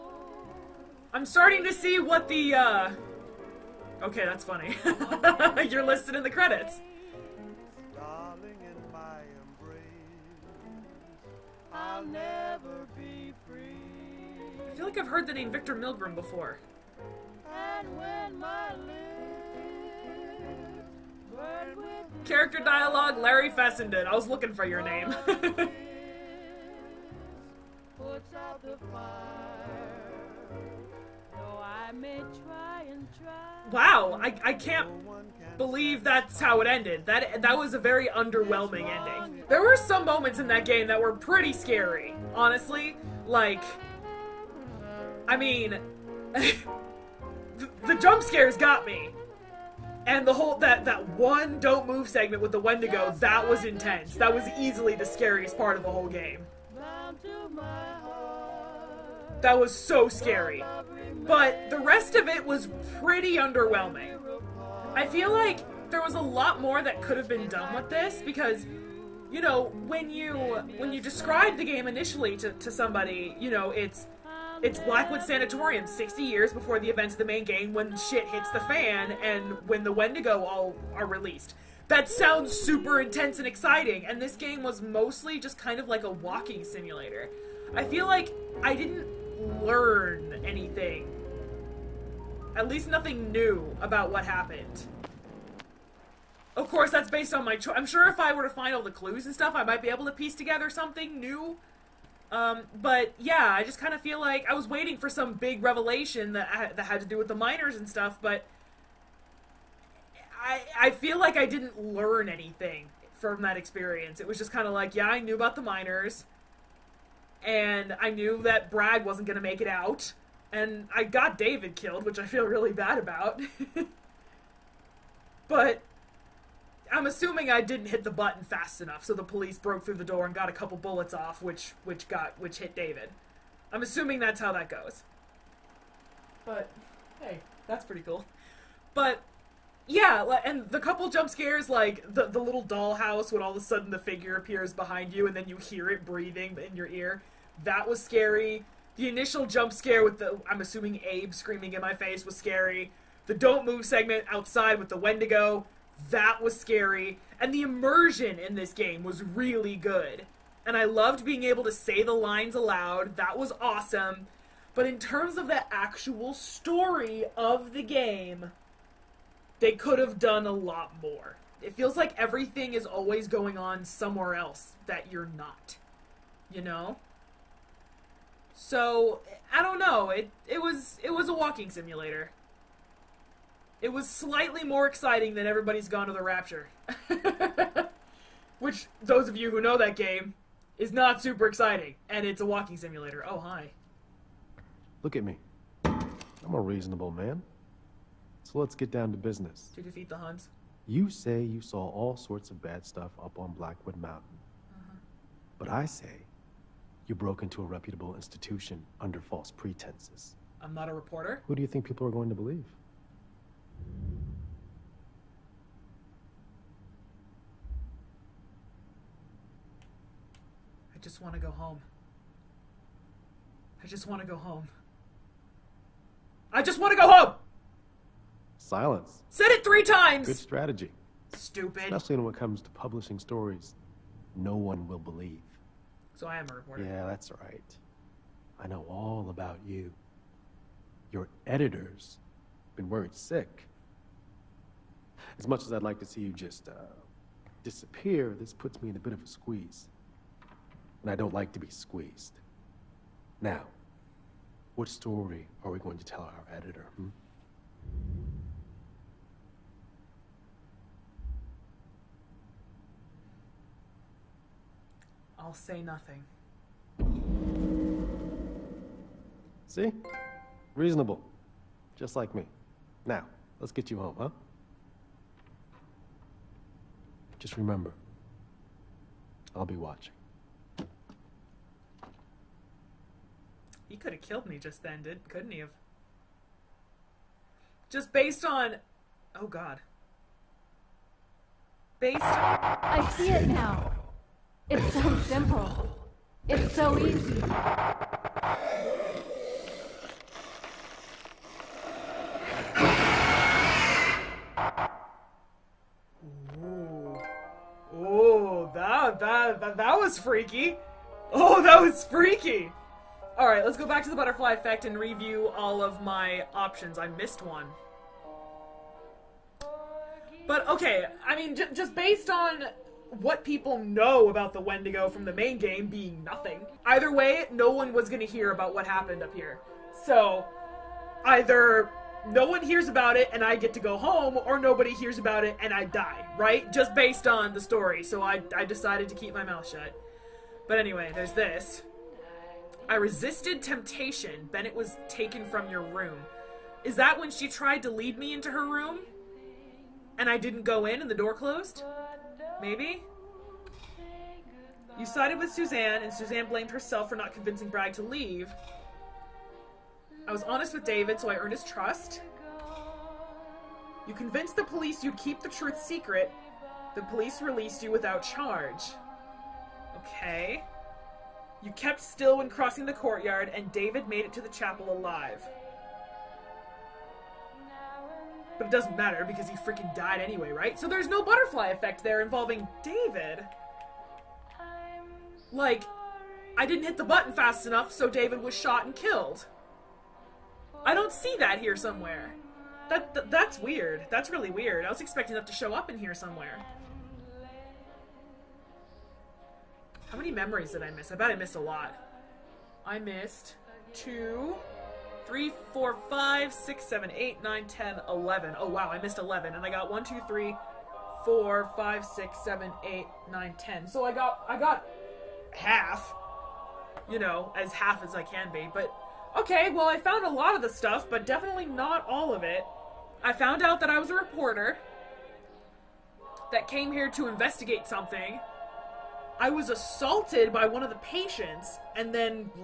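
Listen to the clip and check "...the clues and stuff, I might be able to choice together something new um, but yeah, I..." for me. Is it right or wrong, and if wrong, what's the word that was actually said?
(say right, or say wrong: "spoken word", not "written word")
wrong: "piece", not "choice".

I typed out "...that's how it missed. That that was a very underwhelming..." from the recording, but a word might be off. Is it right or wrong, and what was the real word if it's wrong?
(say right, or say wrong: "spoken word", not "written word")
wrong: "ended", not "missed".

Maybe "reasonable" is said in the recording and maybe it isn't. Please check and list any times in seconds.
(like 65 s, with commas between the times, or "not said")
196 s, 270 s.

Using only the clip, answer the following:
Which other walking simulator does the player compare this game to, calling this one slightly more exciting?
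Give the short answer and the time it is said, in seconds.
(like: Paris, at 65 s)
Everybody's Gone to the Rapture, at 185 s.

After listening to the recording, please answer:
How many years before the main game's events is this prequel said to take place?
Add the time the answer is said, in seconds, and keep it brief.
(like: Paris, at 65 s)
60, at 75 s.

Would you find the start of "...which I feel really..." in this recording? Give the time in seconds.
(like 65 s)
122 s.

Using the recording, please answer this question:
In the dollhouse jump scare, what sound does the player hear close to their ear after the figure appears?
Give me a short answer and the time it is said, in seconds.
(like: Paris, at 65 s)
Breathing, at 146 s.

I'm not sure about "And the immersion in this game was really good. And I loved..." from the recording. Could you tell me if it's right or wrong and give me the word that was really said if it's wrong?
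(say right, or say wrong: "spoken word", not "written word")
right.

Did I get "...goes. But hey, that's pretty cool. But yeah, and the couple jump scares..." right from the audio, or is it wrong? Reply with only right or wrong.
right.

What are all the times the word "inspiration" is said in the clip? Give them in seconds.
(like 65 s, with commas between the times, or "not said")
not said.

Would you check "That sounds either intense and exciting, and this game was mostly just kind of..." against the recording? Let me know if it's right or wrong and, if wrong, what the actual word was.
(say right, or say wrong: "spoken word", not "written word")
wrong: "super", not "either".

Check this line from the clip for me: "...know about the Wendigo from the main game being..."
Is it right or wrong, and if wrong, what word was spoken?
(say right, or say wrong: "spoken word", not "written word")
right.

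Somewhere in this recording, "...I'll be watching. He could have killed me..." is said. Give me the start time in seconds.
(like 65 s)
279 s.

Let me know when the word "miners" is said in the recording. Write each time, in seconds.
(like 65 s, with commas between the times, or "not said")
107 s, 115 s.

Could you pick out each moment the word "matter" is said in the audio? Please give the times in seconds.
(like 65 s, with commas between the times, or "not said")
378 s.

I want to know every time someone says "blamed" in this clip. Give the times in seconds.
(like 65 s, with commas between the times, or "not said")
356 s.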